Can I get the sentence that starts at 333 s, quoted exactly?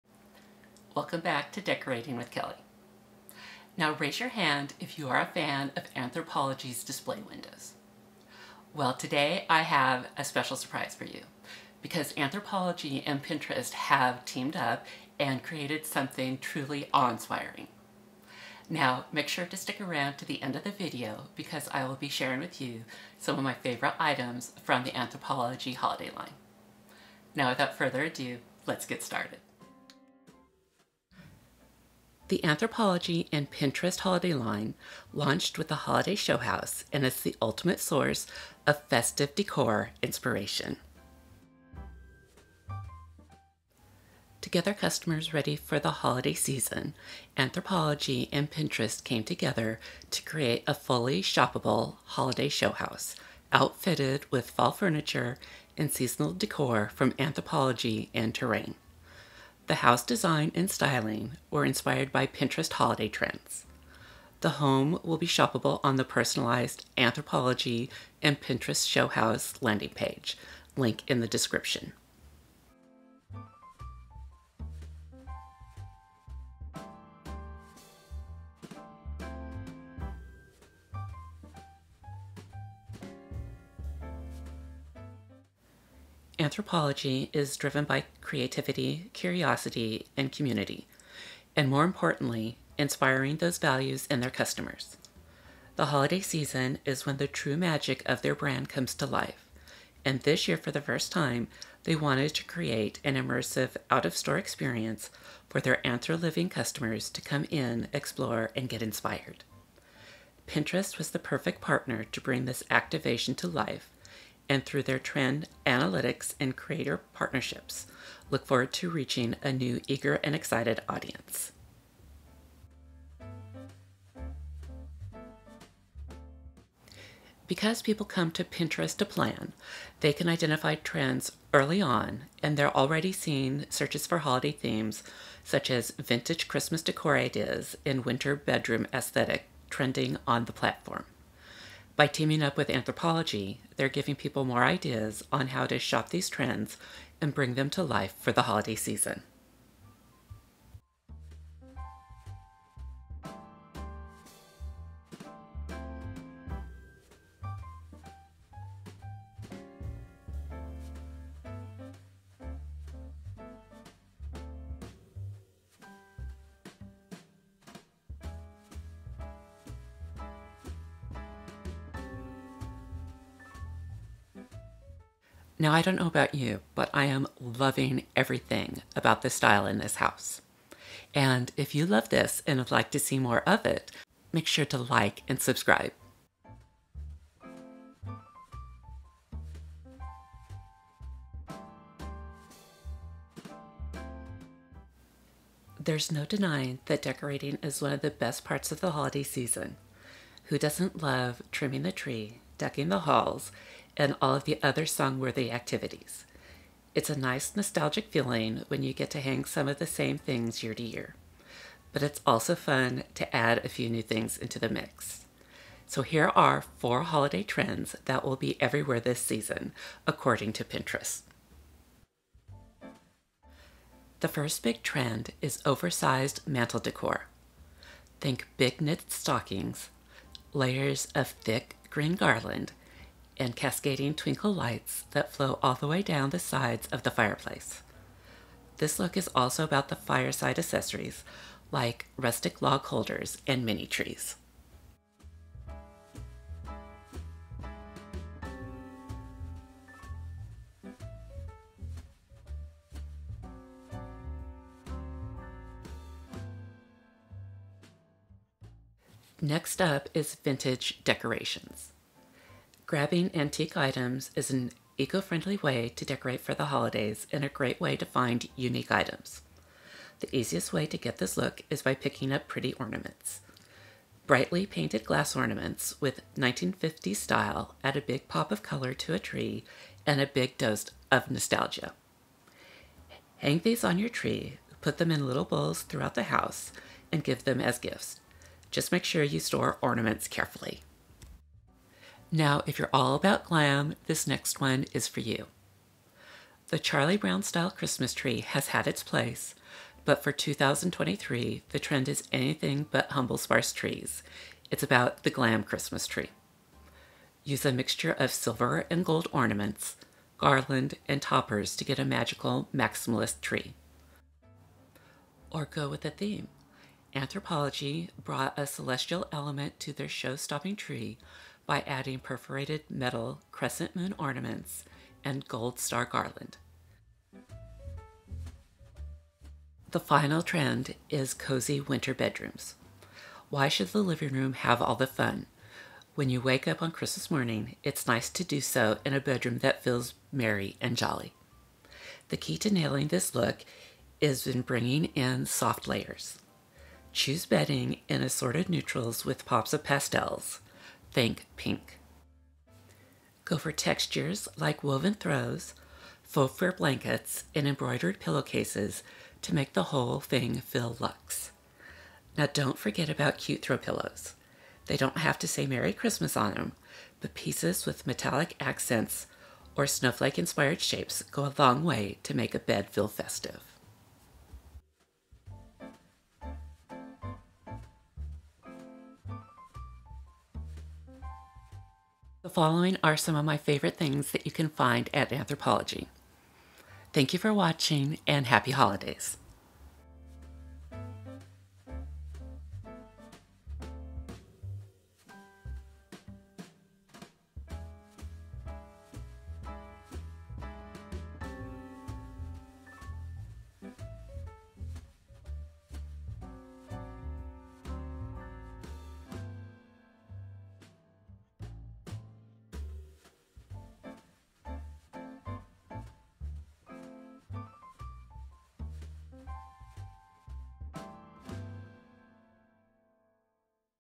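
Why should the living room have all the fun?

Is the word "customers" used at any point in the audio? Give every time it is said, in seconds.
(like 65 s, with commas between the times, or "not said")
44 s, 94 s, 106 s.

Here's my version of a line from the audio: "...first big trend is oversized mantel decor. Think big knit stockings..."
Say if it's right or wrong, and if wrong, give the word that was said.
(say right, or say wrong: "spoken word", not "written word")
right.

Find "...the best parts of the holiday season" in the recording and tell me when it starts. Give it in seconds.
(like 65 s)
198 s.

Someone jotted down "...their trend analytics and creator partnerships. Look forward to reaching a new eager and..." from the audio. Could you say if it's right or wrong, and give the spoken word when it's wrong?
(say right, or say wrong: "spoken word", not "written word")
right.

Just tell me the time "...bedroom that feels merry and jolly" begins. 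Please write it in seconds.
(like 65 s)
339 s.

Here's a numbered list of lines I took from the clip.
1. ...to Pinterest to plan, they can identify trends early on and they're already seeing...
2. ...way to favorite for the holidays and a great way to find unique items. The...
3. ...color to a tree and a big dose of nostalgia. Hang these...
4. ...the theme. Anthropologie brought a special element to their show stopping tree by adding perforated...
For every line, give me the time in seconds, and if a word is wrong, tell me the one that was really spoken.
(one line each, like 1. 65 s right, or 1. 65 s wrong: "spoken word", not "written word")
1. 128 s right
2. 265 s wrong: "decorate", not "favorite"
3. 278 s right
4. 316 s wrong: "celestial", not "special".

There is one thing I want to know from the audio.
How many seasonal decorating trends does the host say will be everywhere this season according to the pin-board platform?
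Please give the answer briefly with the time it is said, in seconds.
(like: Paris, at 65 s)
4, at 216 s.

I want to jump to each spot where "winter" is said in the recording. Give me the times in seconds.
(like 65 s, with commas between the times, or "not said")
138 s, 331 s.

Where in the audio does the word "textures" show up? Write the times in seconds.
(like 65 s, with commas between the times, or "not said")
353 s.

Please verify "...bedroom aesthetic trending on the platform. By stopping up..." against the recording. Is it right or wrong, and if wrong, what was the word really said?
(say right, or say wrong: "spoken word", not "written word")
wrong: "teaming", not "stopping".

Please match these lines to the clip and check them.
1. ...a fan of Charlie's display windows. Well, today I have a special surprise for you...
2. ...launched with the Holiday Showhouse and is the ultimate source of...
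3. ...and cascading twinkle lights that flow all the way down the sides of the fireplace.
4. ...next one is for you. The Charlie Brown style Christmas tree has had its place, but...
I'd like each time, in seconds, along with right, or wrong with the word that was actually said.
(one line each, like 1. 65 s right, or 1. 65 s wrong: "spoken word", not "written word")
1. 5 s wrong: "Anthropologie", not "Charlie"
2. 35 s right
3. 233 s right
4. 294 s right.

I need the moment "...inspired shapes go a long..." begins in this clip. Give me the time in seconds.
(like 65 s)
370 s.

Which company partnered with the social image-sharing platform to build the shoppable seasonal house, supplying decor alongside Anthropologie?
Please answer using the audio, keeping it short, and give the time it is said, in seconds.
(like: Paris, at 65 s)
Terrain, at 58 s.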